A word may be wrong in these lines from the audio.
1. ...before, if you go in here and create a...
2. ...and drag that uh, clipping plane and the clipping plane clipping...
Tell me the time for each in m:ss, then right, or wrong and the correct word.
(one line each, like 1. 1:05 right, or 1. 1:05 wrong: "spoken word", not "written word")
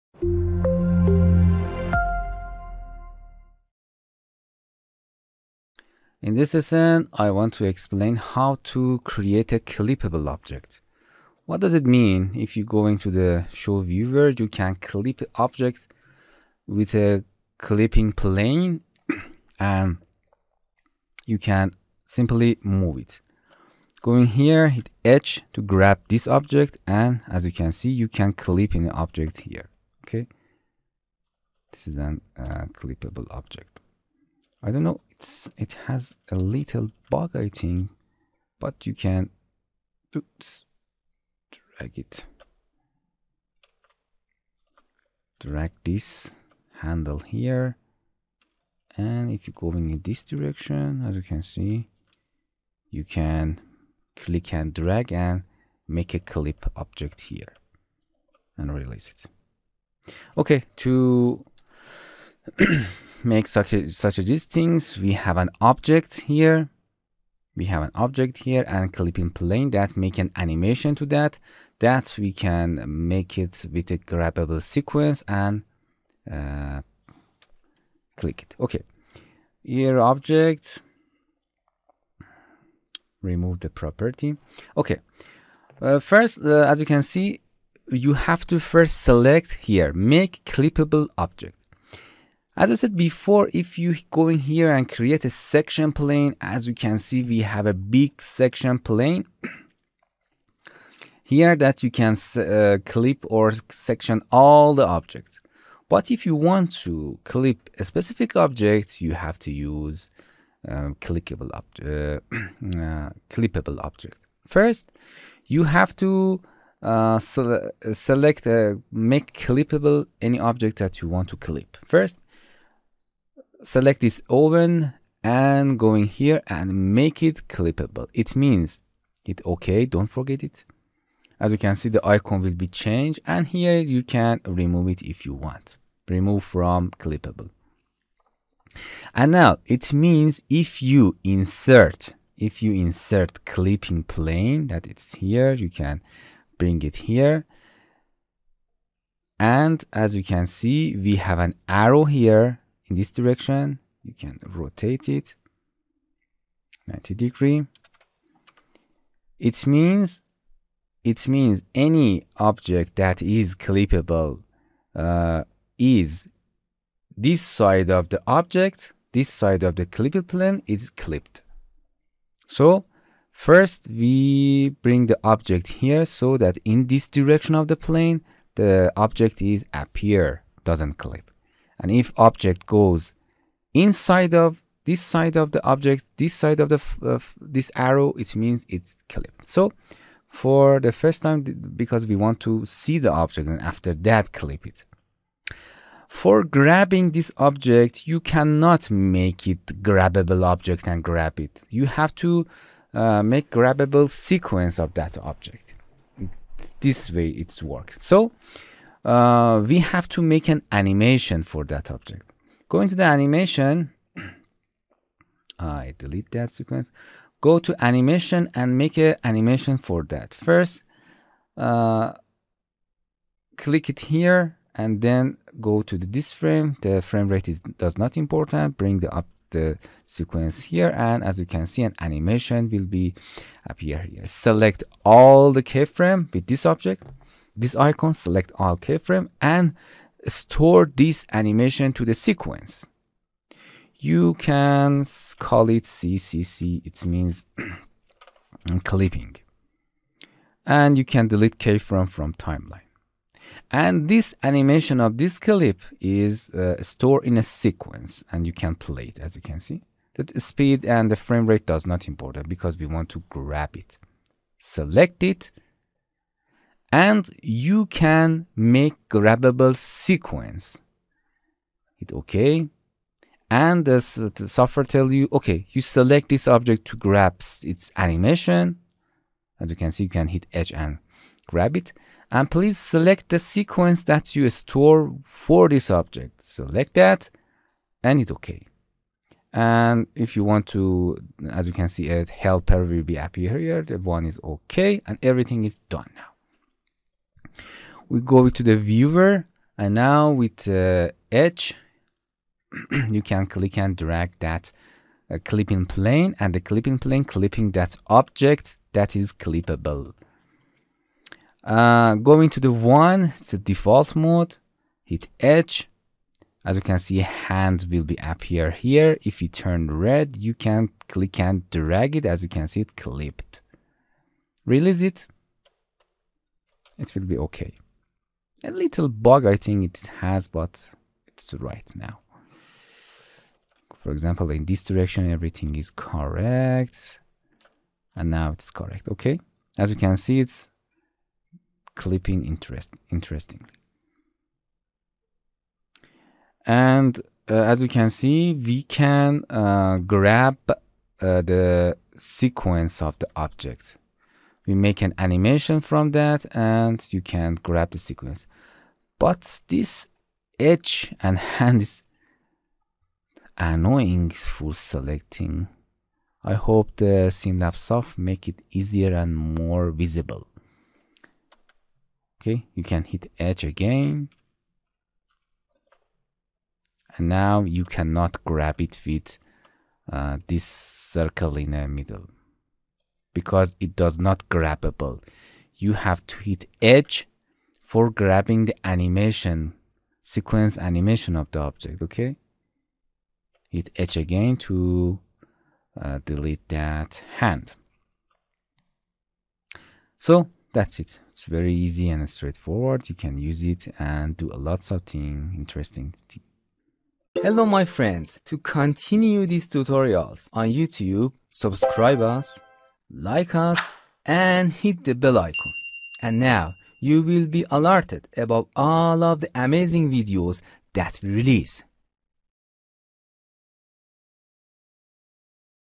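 1. 1:32 right
2. 5:03 right.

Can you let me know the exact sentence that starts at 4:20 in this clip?
The speed and the frame rate does not important because we want to grab it.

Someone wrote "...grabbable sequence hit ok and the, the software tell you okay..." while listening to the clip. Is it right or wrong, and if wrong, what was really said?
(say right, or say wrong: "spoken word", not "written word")
right.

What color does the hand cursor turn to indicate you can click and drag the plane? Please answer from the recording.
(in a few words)
Red.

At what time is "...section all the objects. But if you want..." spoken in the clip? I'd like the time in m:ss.
1:43.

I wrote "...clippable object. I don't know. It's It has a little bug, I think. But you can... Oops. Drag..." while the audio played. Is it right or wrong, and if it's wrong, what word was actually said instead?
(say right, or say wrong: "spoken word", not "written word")
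right.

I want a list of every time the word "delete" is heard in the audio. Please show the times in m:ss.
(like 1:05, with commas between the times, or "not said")
3:35, 4:11, 6:36.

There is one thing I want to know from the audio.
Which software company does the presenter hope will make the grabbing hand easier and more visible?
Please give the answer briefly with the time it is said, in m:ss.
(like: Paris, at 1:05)
SimLab soft, at 6:07.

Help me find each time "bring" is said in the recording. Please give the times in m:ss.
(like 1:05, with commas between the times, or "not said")
2:26, 2:54, 3:48.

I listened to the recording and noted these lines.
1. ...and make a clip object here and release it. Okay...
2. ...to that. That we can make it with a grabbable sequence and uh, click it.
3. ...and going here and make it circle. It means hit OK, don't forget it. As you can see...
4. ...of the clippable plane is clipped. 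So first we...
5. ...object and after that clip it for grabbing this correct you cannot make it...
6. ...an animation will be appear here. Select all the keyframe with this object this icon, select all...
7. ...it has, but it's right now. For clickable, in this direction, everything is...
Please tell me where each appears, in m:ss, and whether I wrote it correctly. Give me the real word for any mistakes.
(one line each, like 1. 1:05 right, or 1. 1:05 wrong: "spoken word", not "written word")
1. 0:55 right
2. 1:10 right
3. 2:05 wrong: "clippable", not "circle"
4. 2:49 right
5. 3:13 wrong: "object", not "correct"
6. 3:51 right
7. 5:29 wrong: "example", not "clickable".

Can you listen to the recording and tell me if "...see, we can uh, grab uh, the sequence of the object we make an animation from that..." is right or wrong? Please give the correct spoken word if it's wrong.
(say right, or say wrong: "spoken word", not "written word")
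right.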